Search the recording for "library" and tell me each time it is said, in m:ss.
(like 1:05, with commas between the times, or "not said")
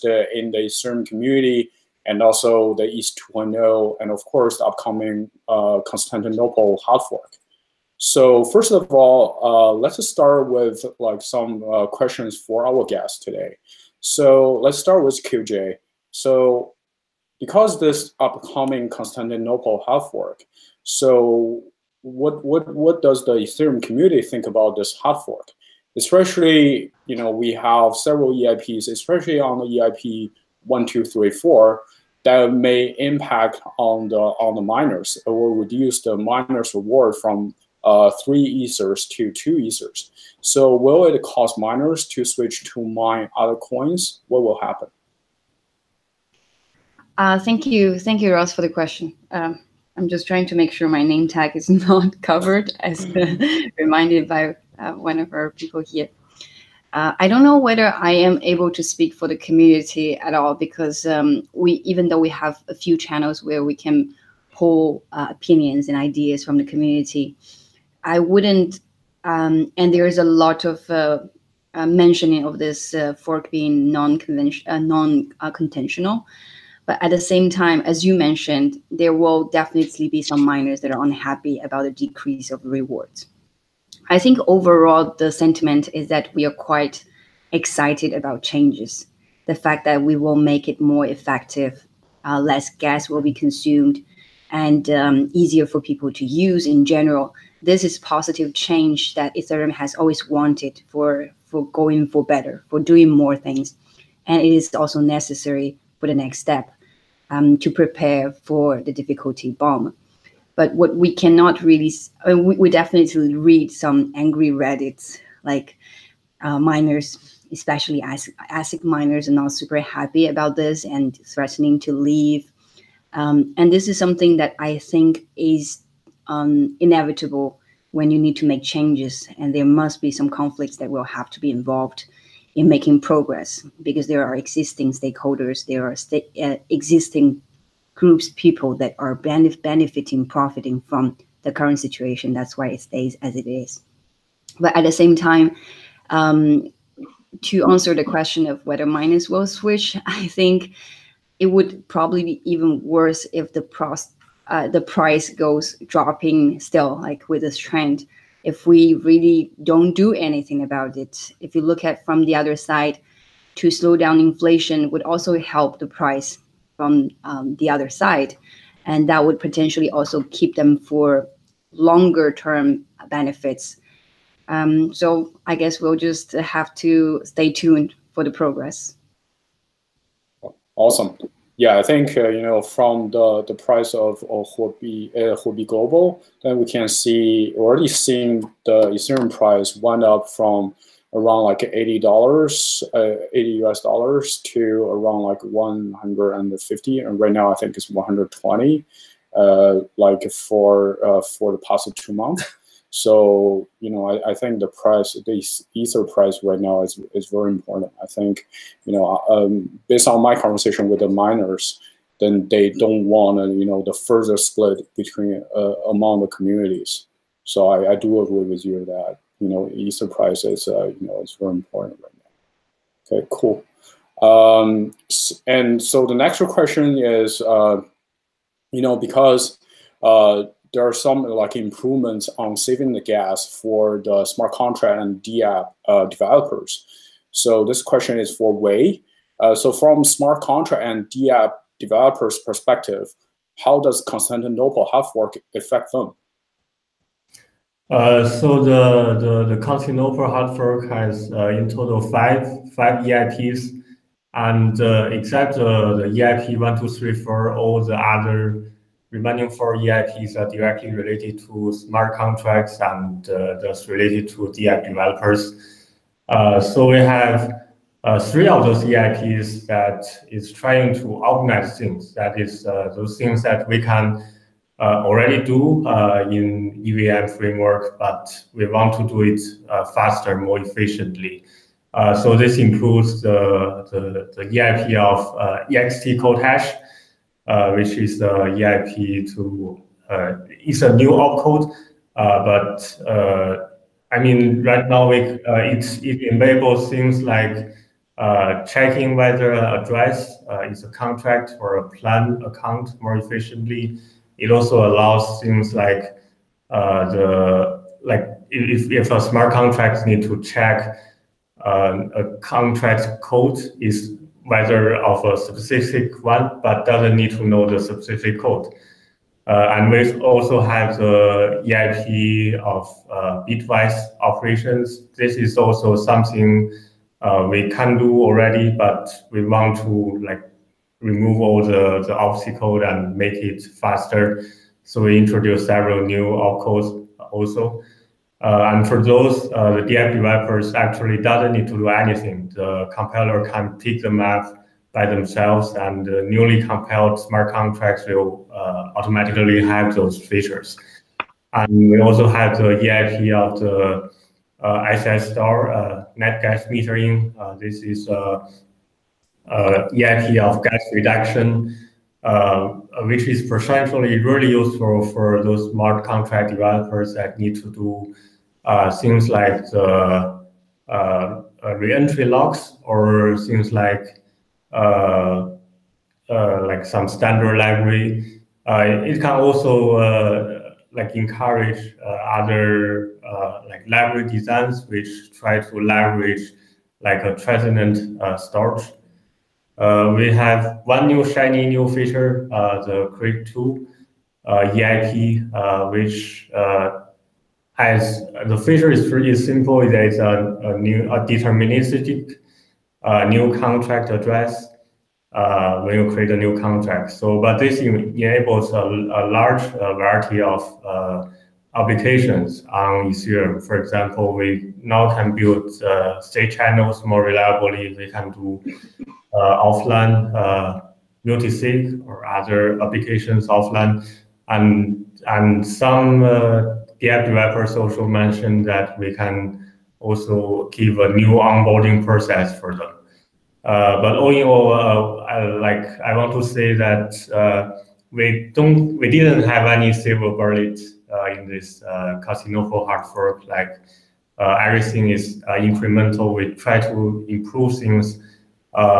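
6:17, 6:23.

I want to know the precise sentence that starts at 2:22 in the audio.
That's why it stays as it is.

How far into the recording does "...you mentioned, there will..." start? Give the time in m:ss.
1:18.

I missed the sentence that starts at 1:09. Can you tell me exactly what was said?
Um, and there is a lot of uh, uh mentioning of this uh, fork being non-conventional, uh, non-contentional.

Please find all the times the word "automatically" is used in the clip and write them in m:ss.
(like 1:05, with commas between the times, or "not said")
5:48.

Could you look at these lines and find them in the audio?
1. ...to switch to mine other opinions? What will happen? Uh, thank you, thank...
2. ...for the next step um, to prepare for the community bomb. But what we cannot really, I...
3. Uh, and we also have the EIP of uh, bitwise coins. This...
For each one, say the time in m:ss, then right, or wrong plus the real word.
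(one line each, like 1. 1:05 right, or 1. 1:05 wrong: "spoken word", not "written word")
1. 0:42 wrong: "coins", not "opinions"
2. 1:45 wrong: "difficulty", not "community"
3. 5:19 wrong: "operations", not "coins".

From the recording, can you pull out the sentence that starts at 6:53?
For example, we now can build uh, state channels more reliably.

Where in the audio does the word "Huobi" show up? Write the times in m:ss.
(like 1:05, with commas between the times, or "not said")
3:04.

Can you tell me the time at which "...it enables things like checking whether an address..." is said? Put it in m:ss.
4:55.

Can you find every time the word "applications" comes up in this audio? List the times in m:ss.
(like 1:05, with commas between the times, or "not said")
6:51, 7:02.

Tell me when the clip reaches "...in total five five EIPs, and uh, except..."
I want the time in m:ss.
4:11.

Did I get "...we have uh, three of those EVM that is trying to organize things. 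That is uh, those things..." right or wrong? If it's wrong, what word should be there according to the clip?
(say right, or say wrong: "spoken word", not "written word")
wrong: "EIPs", not "EVM".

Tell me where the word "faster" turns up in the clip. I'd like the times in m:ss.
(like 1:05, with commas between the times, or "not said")
4:39, 5:33.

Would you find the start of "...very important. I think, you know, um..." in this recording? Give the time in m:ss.
3:27.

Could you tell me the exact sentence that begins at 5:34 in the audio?
So we introduce several new opcodes also.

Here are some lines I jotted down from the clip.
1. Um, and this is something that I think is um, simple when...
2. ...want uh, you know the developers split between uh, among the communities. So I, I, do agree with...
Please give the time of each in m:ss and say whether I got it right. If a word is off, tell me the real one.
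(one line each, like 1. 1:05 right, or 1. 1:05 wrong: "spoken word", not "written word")
1. 2:03 wrong: "inevitable", not "simple"
2. 3:33 wrong: "further", not "developers".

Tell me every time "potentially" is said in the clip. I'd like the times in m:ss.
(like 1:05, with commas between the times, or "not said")
2:49, 6:03.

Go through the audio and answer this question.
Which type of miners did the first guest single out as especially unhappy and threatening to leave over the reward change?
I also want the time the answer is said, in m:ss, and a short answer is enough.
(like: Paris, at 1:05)
ASIC miners, at 1:58.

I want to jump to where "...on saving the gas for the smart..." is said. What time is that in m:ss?
3:52.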